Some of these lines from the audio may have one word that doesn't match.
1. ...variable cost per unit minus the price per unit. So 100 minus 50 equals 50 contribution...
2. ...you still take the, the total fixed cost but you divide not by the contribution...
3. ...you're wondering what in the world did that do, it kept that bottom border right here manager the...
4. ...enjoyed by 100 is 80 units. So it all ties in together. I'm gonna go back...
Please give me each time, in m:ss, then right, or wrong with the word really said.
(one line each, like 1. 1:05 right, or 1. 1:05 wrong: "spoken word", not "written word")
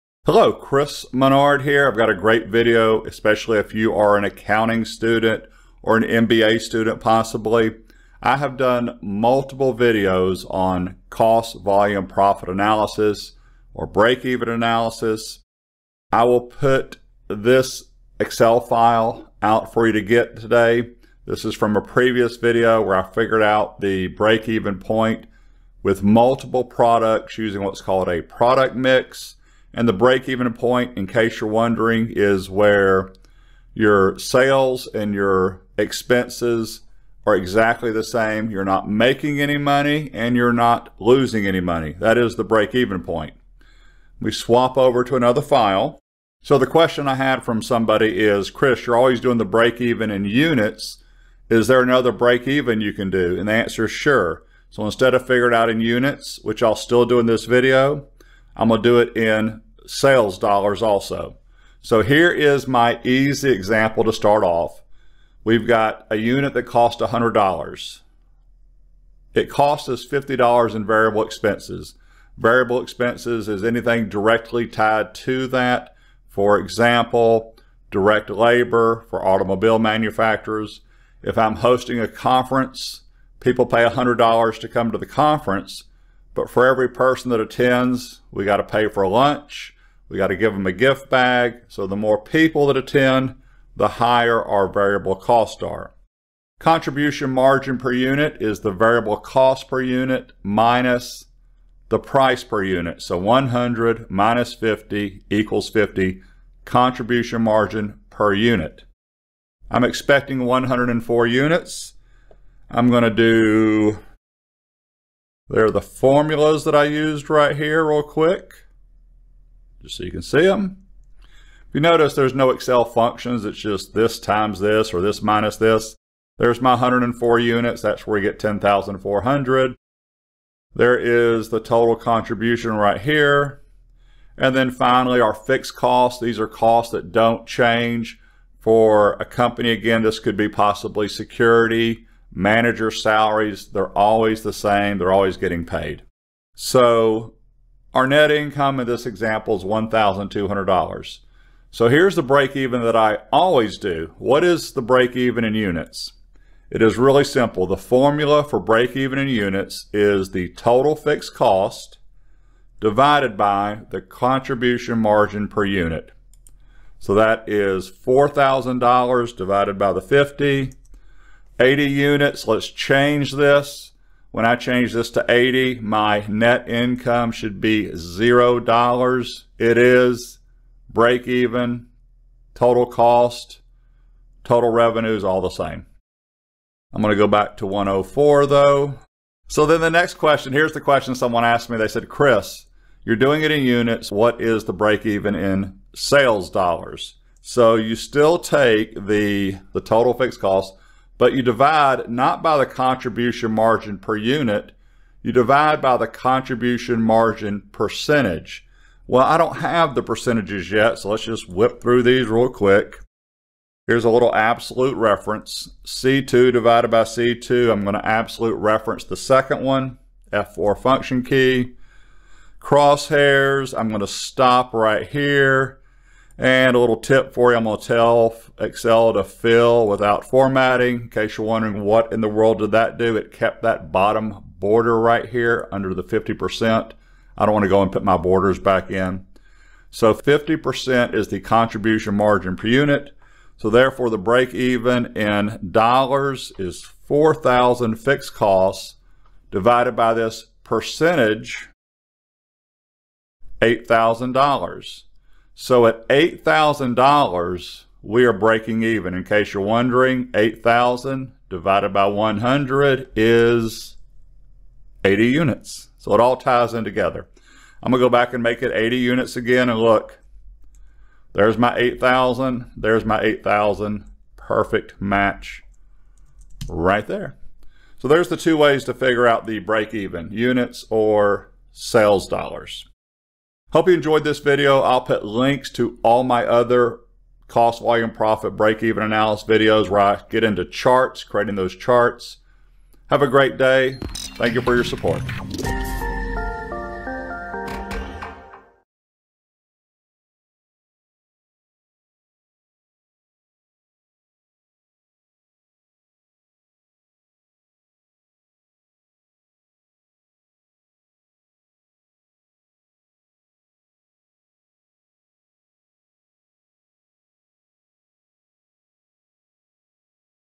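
1. 1:38 right
2. 3:17 right
3. 3:51 wrong: "under", not "manager"
4. 4:21 wrong: "divided", not "enjoyed".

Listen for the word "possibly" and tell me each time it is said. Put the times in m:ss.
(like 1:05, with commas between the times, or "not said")
0:07, 2:20.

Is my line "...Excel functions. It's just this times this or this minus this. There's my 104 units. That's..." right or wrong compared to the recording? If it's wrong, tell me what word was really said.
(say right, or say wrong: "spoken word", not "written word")
right.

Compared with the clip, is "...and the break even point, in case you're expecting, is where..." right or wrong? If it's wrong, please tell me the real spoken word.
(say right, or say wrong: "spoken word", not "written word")
wrong: "wondering", not "expecting".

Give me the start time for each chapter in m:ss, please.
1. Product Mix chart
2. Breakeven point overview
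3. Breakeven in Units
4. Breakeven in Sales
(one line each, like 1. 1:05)
1. 0:18
2. 0:48
3. 2:33
4. 3:10.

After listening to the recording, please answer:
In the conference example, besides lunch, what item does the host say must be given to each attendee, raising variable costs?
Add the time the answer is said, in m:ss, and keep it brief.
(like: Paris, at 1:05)
Gift bag, at 1:30.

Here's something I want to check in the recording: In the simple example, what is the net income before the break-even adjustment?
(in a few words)
$1,200.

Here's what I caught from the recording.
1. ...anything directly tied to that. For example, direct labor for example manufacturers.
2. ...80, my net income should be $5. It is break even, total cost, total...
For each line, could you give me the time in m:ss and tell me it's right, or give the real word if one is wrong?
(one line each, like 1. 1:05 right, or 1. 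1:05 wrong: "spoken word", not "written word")
1. 1:13 wrong: "automobile", not "example"
2. 2:55 wrong: "0", not "5".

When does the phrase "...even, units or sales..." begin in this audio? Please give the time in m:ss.
4:39.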